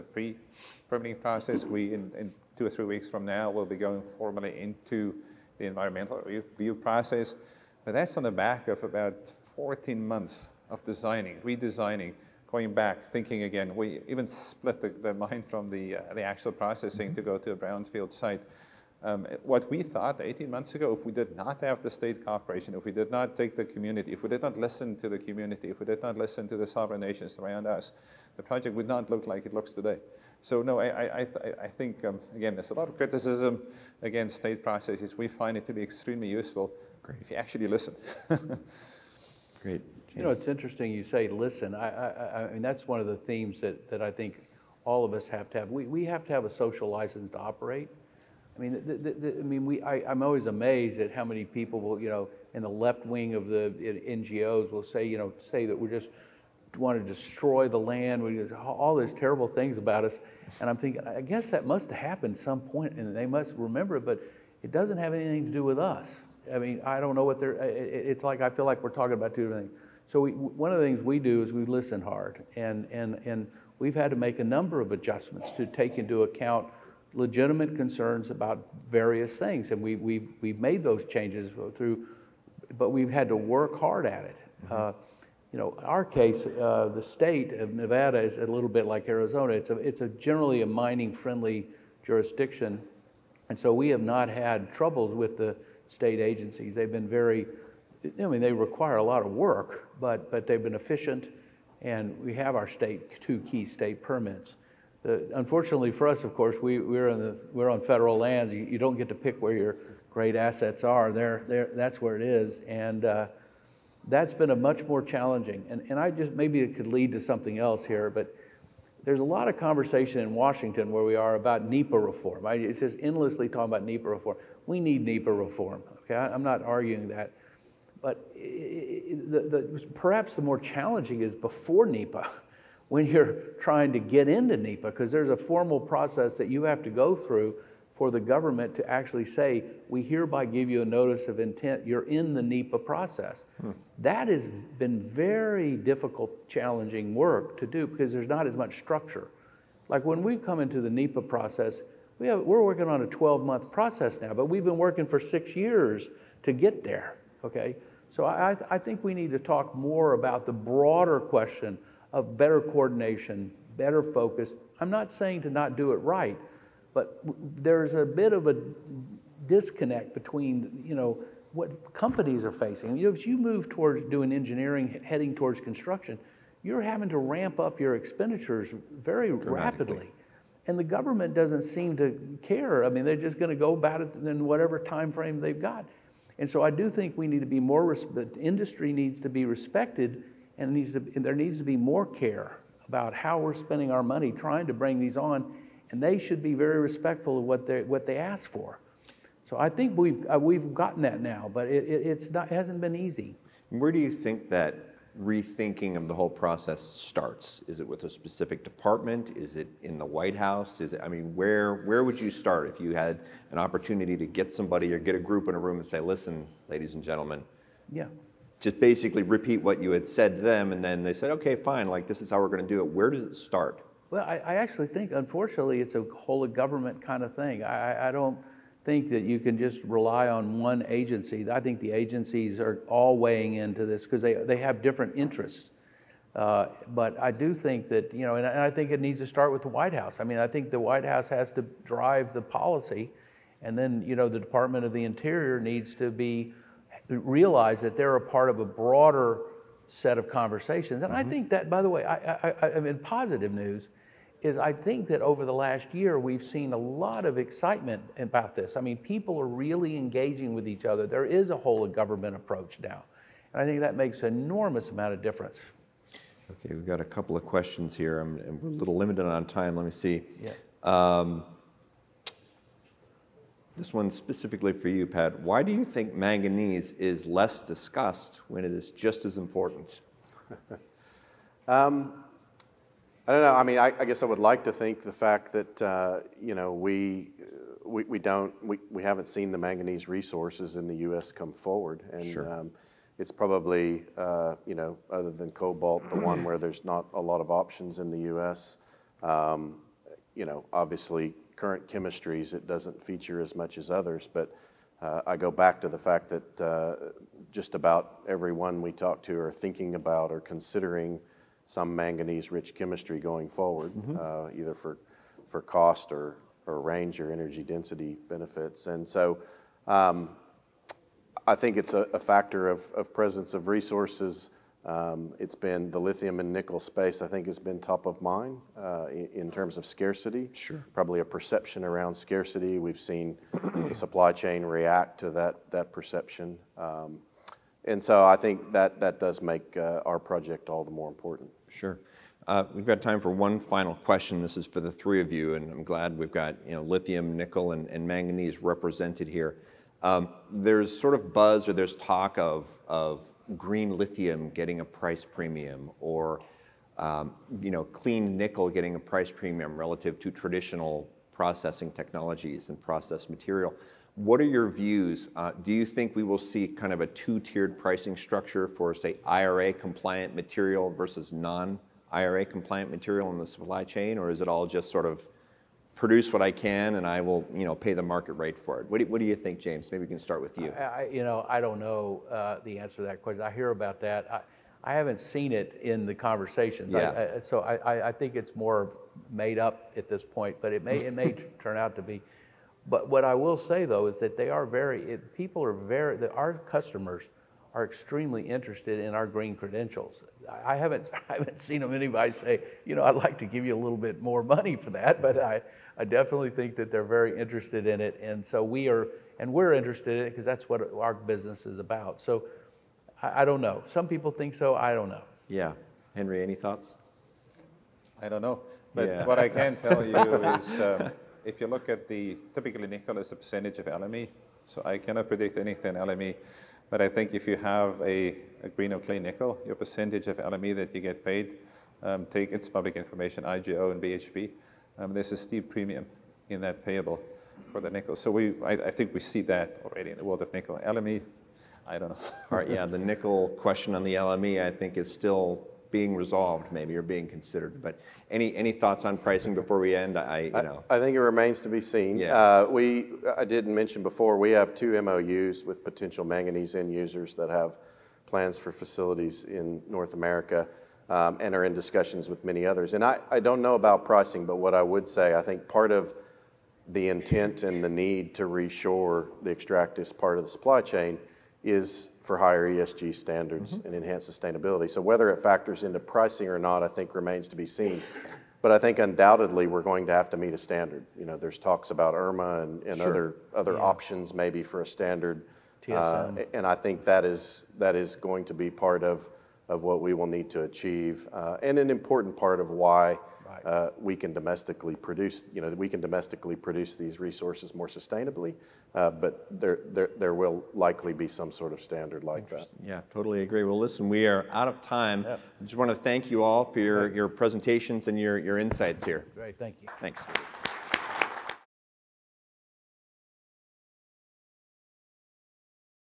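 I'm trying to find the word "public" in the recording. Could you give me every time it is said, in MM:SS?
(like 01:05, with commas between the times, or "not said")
07:12.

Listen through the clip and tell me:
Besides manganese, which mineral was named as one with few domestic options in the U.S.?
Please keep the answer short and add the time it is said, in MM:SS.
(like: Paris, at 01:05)
Cobalt, at 04:55.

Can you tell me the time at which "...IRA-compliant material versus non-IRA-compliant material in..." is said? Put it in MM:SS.
06:09.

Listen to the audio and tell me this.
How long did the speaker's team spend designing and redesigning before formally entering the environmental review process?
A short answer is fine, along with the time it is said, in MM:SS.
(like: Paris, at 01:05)
14 months, at 00:09.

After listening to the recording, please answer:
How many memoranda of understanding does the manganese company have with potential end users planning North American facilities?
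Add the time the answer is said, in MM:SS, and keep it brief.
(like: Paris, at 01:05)
2, at 07:34.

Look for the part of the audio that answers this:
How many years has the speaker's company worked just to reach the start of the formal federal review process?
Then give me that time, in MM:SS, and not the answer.
02:35.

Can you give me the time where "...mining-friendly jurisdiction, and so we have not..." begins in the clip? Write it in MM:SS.
01:30.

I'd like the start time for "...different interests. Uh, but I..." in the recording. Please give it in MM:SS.
03:54.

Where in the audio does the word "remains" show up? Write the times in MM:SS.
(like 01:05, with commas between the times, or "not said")
07:31, 07:57.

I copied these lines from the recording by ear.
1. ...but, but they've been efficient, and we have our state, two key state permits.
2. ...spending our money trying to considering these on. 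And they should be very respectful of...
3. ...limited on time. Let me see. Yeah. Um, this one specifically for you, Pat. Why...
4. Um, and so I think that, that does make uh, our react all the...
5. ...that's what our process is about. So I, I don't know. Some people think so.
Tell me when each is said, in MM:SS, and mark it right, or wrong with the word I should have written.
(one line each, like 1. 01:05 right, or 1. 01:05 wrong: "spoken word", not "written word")
1. 01:39 right
2. 03:13 wrong: "bring", not "considering"
3. 04:28 right
4. 05:36 wrong: "project", not "react"
5. 06:50 wrong: "business", not "process".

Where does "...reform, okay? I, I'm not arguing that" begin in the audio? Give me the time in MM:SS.
02:05.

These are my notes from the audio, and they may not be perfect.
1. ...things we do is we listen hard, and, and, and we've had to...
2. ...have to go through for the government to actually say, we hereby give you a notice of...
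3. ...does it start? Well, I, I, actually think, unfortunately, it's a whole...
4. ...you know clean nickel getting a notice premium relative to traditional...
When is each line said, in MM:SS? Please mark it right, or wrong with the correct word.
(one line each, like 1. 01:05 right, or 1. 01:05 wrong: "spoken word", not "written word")
1. 01:10 right
2. 02:16 right
3. 03:43 right
4. 05:57 wrong: "price", not "notice".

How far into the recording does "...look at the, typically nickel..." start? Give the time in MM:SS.
07:01.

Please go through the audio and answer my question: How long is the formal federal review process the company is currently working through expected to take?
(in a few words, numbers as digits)
12 months.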